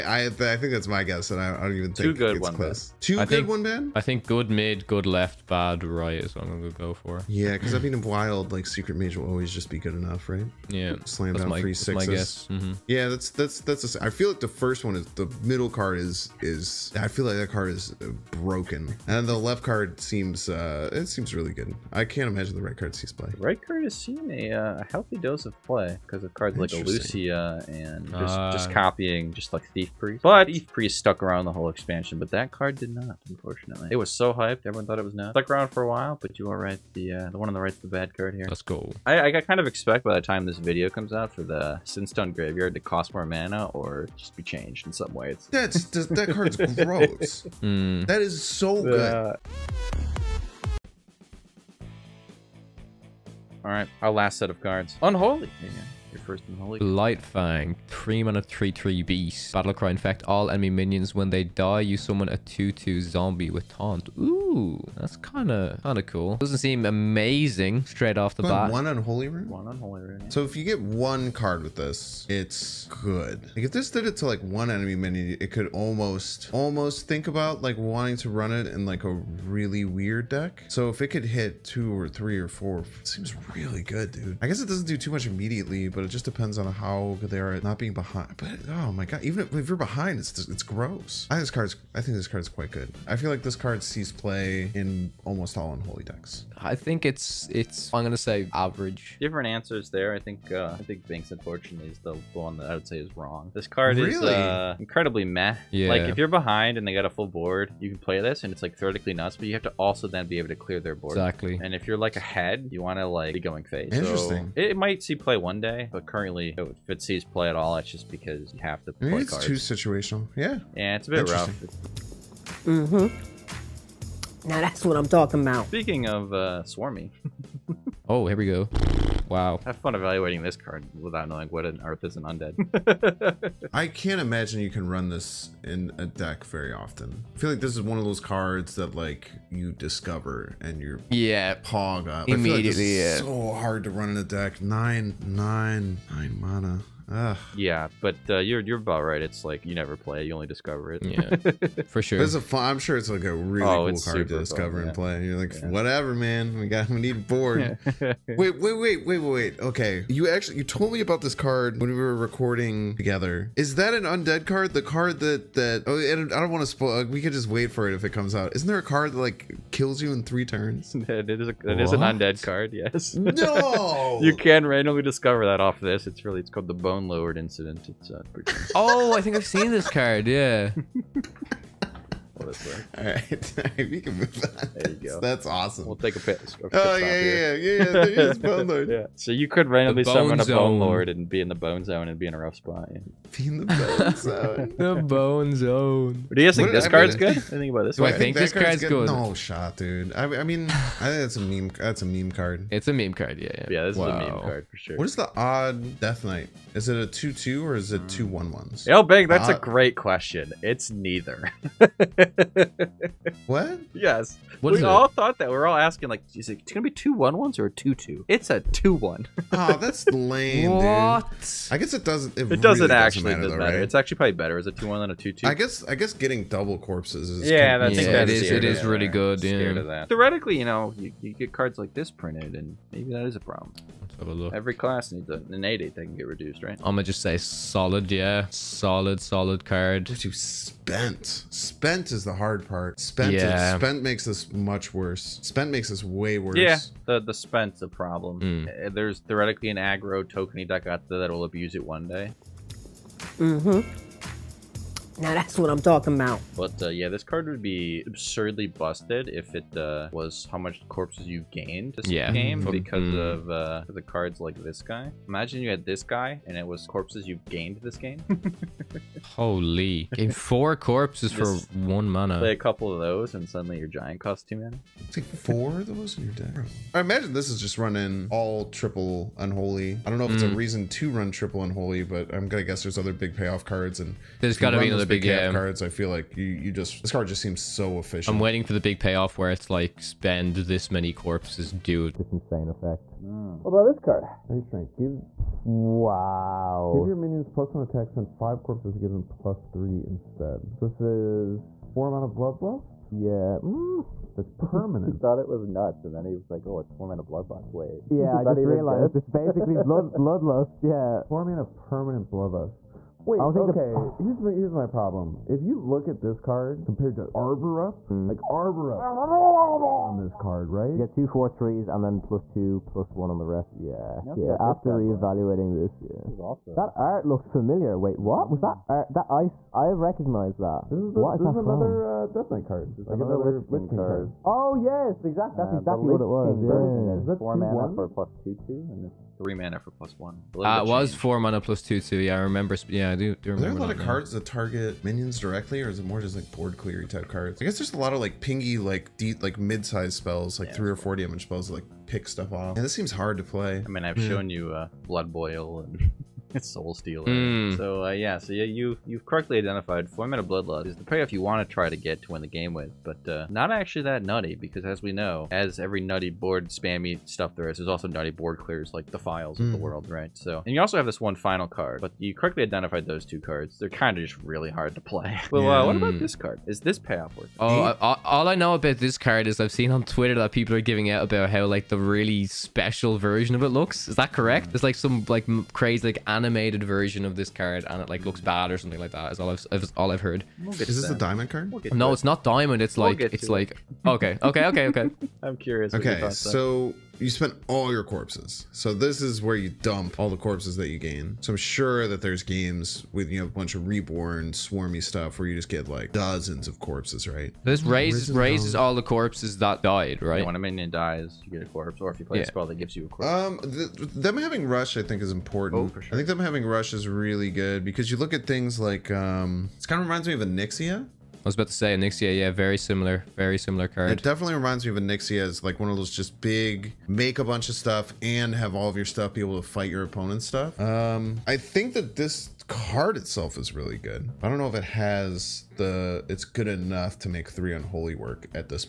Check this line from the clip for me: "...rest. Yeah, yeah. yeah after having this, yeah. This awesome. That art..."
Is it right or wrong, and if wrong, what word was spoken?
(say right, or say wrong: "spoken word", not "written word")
wrong: "reevaluating", not "having".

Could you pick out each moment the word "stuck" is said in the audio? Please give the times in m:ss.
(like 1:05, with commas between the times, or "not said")
0:30, 0:35.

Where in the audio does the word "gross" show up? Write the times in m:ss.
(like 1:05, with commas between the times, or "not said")
0:46, 1:30.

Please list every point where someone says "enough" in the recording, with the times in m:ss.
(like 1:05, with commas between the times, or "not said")
0:09, 7:16.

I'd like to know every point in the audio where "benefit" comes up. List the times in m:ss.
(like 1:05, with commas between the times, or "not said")
not said.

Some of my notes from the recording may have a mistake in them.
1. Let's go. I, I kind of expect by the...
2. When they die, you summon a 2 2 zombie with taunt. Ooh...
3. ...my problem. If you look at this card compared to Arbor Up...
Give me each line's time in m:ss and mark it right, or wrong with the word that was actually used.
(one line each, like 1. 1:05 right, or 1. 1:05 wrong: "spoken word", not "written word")
1. 0:38 right
2. 1:01 right
3. 5:14 right.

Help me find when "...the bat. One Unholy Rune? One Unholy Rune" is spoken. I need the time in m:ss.
1:08.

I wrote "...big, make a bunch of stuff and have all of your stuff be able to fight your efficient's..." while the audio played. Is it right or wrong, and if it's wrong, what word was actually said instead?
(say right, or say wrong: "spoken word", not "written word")
wrong: "opponent", not "efficient".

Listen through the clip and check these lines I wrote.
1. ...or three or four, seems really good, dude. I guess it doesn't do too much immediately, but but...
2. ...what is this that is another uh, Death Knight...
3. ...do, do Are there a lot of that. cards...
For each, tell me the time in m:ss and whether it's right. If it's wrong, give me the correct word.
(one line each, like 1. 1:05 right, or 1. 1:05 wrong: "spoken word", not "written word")
1. 1:21 right
2. 5:31 right
3. 5:43 right.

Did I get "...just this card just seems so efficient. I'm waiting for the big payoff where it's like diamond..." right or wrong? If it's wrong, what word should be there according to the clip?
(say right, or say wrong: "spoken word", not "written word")
wrong: "spend", not "diamond".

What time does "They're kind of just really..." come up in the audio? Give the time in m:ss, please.
6:13.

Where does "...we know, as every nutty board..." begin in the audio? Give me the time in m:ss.
6:05.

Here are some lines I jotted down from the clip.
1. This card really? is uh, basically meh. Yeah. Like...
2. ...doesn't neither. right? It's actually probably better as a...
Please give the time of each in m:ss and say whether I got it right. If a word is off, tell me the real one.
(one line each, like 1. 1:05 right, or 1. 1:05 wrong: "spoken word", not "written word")
1. 1:43 wrong: "incredibly", not "basically"
2. 3:43 wrong: "matter", not "neither".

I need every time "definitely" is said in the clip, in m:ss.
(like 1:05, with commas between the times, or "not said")
7:04.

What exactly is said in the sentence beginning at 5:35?
That's uh, exactly what it was.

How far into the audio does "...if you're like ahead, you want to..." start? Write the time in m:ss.
1:51.